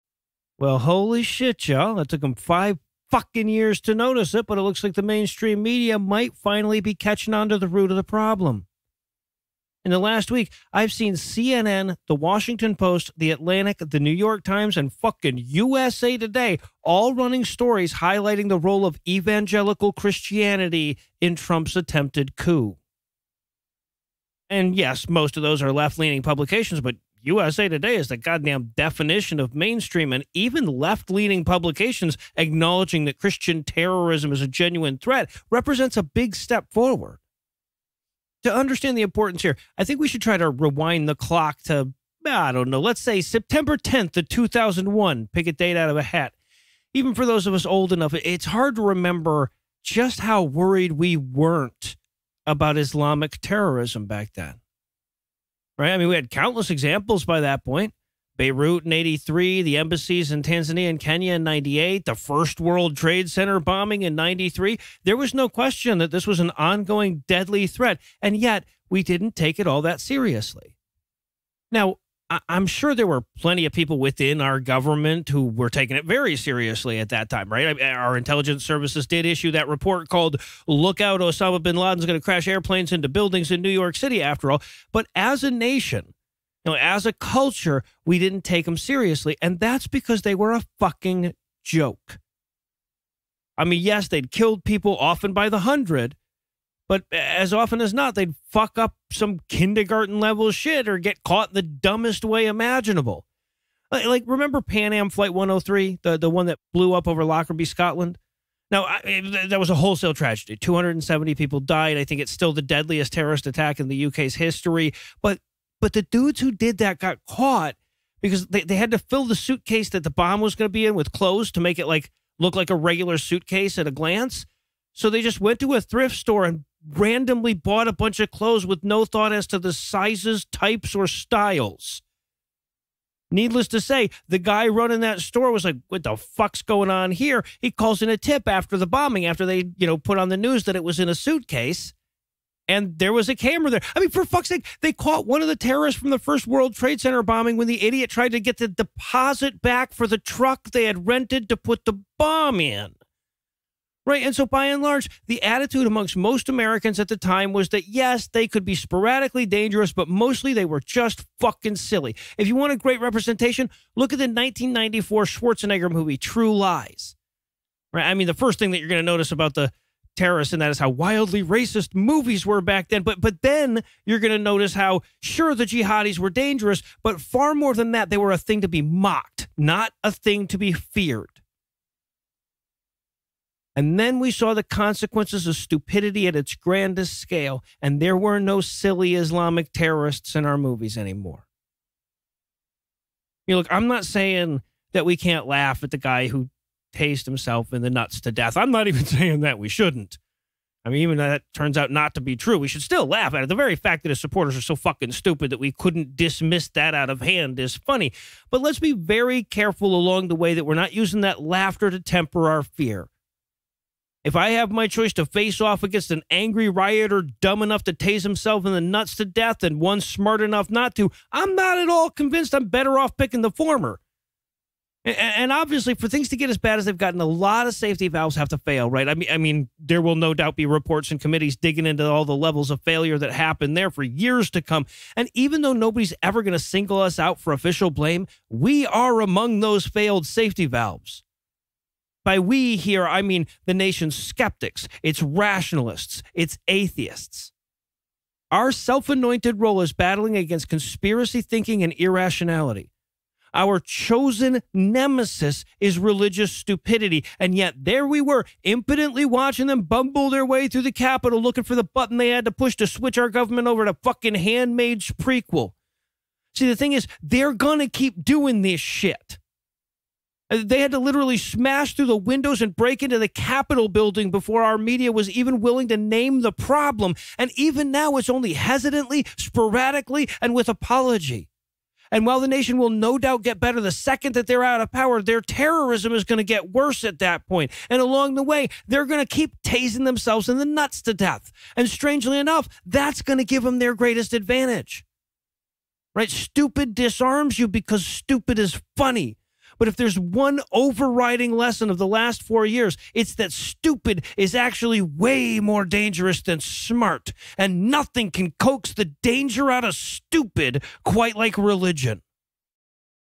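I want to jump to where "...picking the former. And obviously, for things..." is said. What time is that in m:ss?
3:43.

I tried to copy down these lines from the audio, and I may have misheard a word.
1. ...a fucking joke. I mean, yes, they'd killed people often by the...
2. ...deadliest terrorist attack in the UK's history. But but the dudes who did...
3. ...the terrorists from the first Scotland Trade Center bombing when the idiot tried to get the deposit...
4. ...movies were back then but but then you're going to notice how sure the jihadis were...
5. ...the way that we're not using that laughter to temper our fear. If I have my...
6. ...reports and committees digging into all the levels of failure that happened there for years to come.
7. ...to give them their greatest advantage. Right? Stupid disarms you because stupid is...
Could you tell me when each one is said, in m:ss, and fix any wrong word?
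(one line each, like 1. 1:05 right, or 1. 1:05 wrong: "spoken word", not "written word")
1. 1:30 right
2. 1:52 right
3. 2:25 wrong: "World", not "Scotland"
4. 2:51 right
5. 3:30 right
6. 3:50 right
7. 4:53 right.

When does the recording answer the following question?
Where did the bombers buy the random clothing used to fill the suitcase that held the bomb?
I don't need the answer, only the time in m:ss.
2:05.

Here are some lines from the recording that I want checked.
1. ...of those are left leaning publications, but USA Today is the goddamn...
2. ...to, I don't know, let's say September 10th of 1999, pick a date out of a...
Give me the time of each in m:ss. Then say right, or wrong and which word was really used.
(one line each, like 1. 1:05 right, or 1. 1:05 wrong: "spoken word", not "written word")
1. 0:25 right
2. 0:41 wrong: "2001", not "1999".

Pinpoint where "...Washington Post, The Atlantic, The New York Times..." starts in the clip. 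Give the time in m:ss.
0:12.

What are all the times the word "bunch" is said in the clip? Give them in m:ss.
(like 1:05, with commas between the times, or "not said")
2:07.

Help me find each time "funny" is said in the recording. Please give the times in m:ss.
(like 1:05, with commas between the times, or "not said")
3:27, 4:58.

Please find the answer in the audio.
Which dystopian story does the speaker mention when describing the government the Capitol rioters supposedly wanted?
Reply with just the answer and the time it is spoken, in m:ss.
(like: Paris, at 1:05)
Handmaid's prequel, at 4:24.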